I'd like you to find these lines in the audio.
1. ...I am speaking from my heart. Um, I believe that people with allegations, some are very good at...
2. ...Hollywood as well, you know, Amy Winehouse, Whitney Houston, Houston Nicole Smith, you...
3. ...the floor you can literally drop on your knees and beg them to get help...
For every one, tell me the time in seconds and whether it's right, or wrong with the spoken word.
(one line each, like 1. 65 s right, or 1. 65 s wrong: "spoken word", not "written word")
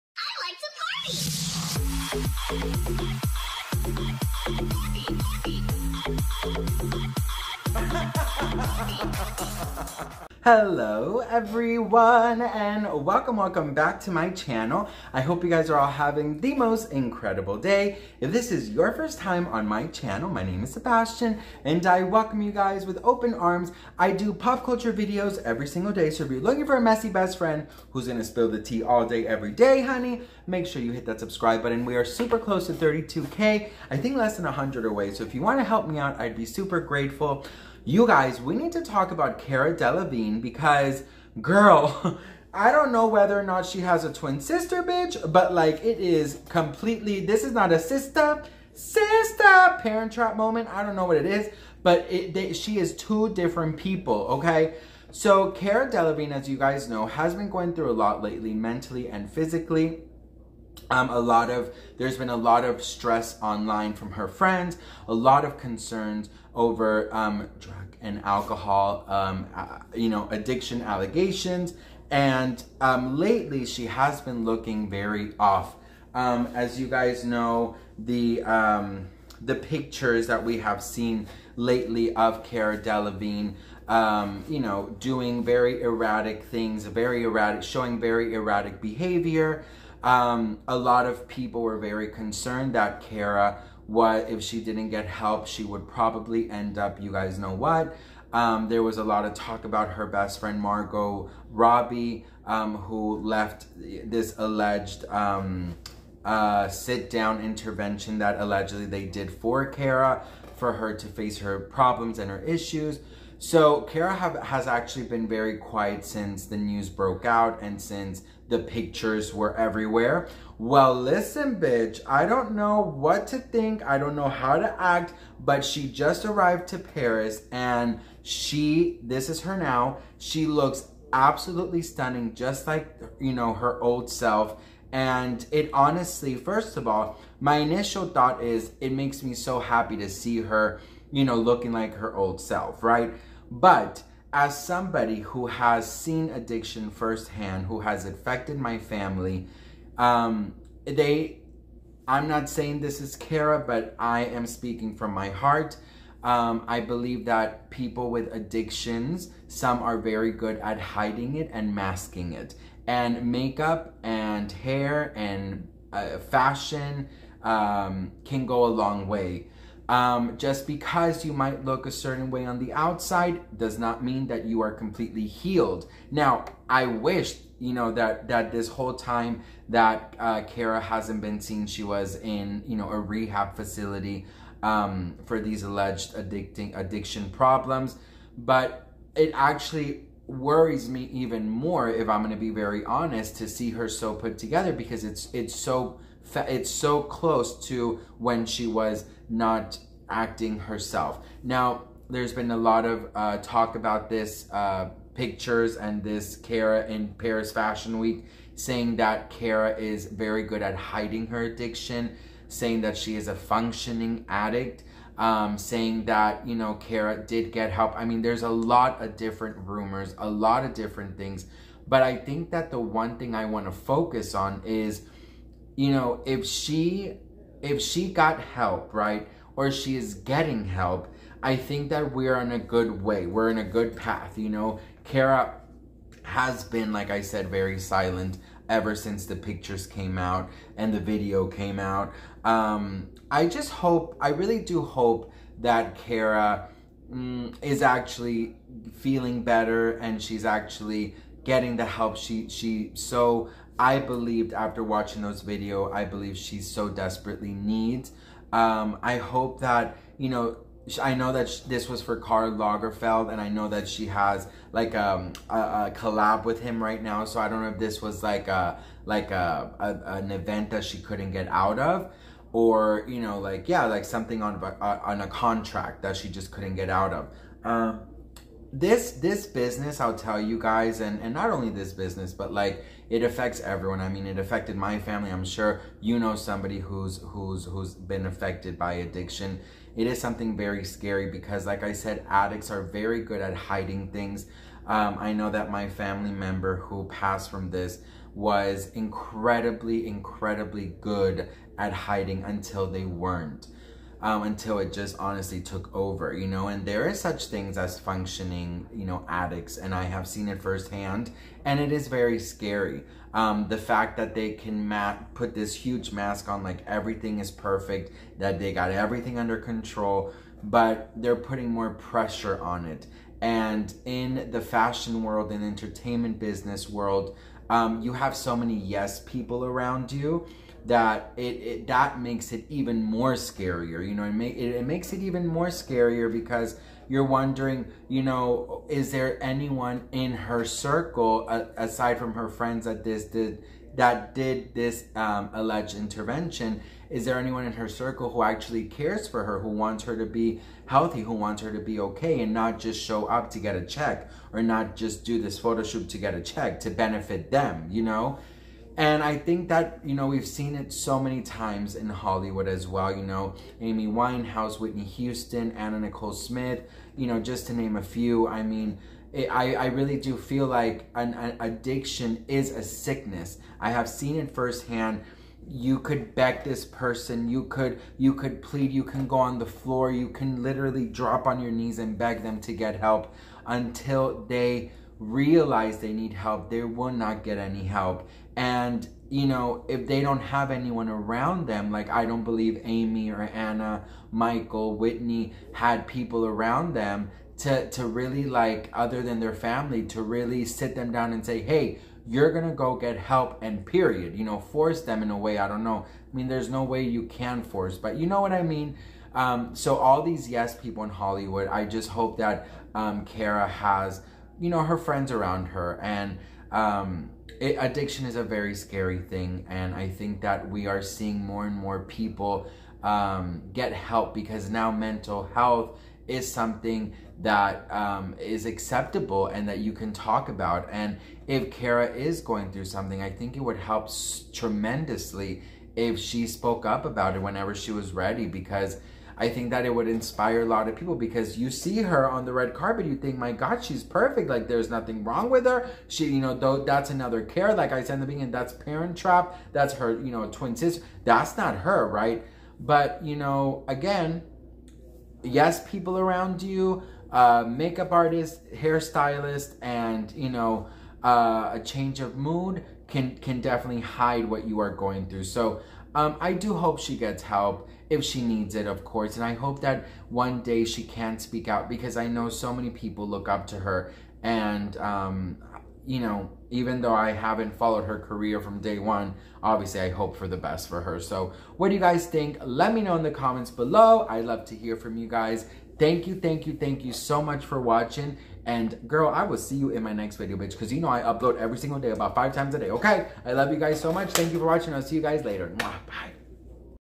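1. 153 s wrong: "addictions", not "allegations"
2. 362 s wrong: "Anna", not "Houston"
3. 379 s right.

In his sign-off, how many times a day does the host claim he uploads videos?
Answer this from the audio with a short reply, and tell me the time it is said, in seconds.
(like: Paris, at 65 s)
5, at 492 s.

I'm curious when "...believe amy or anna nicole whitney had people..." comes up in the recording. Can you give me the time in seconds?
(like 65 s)
392 s.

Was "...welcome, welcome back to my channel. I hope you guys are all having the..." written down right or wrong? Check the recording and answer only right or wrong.
right.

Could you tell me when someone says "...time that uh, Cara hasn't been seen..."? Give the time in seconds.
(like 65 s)
178 s.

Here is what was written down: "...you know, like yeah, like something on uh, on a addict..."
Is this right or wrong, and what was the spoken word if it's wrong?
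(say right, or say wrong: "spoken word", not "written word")
wrong: "contract", not "addict".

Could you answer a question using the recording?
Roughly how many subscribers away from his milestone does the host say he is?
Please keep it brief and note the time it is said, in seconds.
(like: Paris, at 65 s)
less than 100, at 34 s.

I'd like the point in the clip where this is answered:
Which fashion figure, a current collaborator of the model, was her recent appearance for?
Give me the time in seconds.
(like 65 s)
262 s.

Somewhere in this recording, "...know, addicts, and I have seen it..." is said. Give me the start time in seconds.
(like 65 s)
309 s.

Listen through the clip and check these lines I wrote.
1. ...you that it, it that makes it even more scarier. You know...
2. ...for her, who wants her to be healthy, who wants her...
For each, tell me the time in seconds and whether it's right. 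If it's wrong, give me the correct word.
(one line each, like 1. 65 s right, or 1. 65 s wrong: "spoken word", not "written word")
1. 330 s right
2. 349 s right.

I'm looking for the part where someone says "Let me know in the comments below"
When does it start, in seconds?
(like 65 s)
482 s.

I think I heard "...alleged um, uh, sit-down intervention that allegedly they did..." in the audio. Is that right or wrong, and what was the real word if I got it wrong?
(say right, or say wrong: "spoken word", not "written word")
right.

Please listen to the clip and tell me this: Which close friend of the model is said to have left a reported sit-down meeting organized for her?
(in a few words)
Margot Robbie.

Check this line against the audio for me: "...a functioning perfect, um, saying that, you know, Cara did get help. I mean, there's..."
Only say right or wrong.
wrong.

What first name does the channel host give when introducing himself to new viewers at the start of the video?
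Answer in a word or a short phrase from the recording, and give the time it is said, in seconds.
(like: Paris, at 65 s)
Sebastian, at 20 s.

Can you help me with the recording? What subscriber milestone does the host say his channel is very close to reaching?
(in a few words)
32K.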